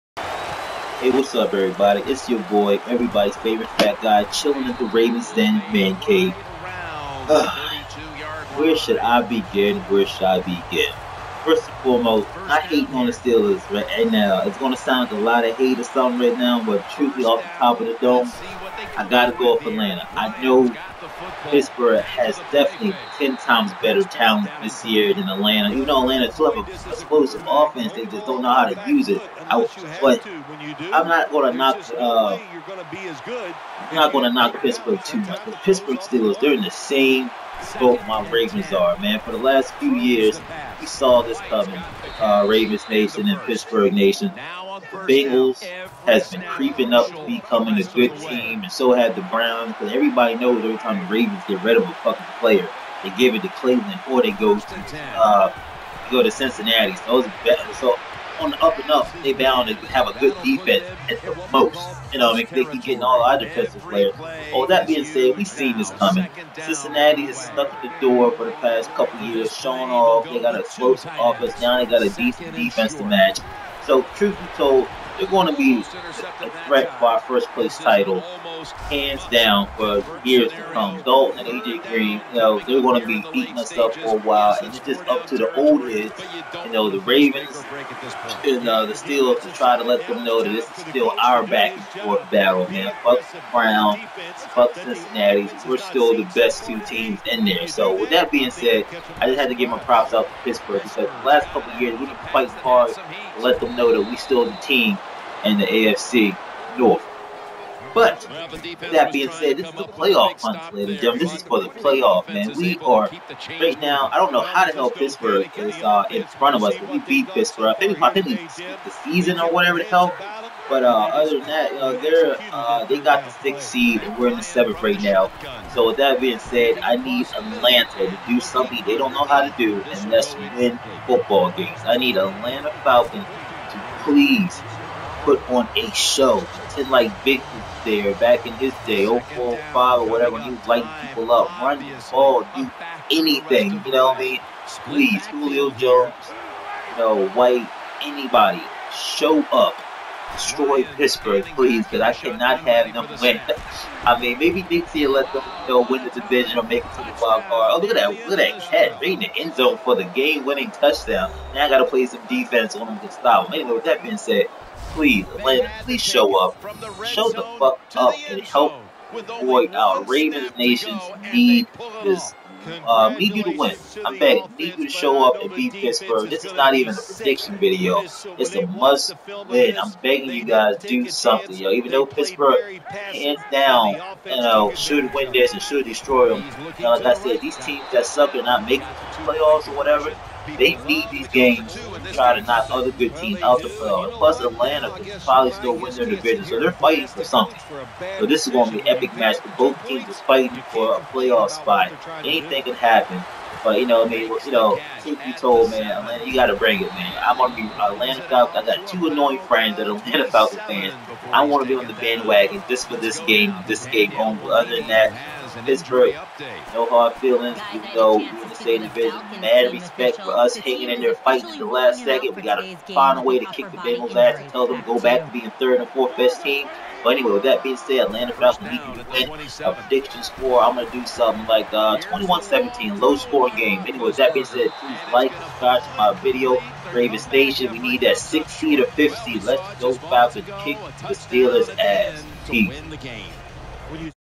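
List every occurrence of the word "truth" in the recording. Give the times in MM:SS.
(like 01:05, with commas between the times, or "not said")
01:14, 03:25.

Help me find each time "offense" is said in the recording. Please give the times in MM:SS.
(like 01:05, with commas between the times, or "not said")
00:27, 01:11.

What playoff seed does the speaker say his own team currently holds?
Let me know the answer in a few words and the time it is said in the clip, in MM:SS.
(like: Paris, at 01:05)
7th, at 02:04.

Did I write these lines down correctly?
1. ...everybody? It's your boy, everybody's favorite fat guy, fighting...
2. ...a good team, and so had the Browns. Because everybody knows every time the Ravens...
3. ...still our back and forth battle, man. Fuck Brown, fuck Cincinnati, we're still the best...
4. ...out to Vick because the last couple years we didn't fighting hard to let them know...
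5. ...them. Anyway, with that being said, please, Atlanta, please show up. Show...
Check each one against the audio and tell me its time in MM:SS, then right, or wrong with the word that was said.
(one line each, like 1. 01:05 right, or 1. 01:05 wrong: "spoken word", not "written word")
1. 00:01 wrong: "chilling", not "fighting"
2. 00:47 right
3. 01:30 right
4. 01:40 wrong: "Pittsburgh", not "Vick"
5. 02:43 right.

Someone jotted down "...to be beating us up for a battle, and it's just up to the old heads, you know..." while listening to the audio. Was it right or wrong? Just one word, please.
wrong.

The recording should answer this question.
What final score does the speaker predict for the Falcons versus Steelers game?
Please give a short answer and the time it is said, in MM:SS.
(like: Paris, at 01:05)
21-17, at 03:51.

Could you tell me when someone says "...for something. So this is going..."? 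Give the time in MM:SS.
03:17.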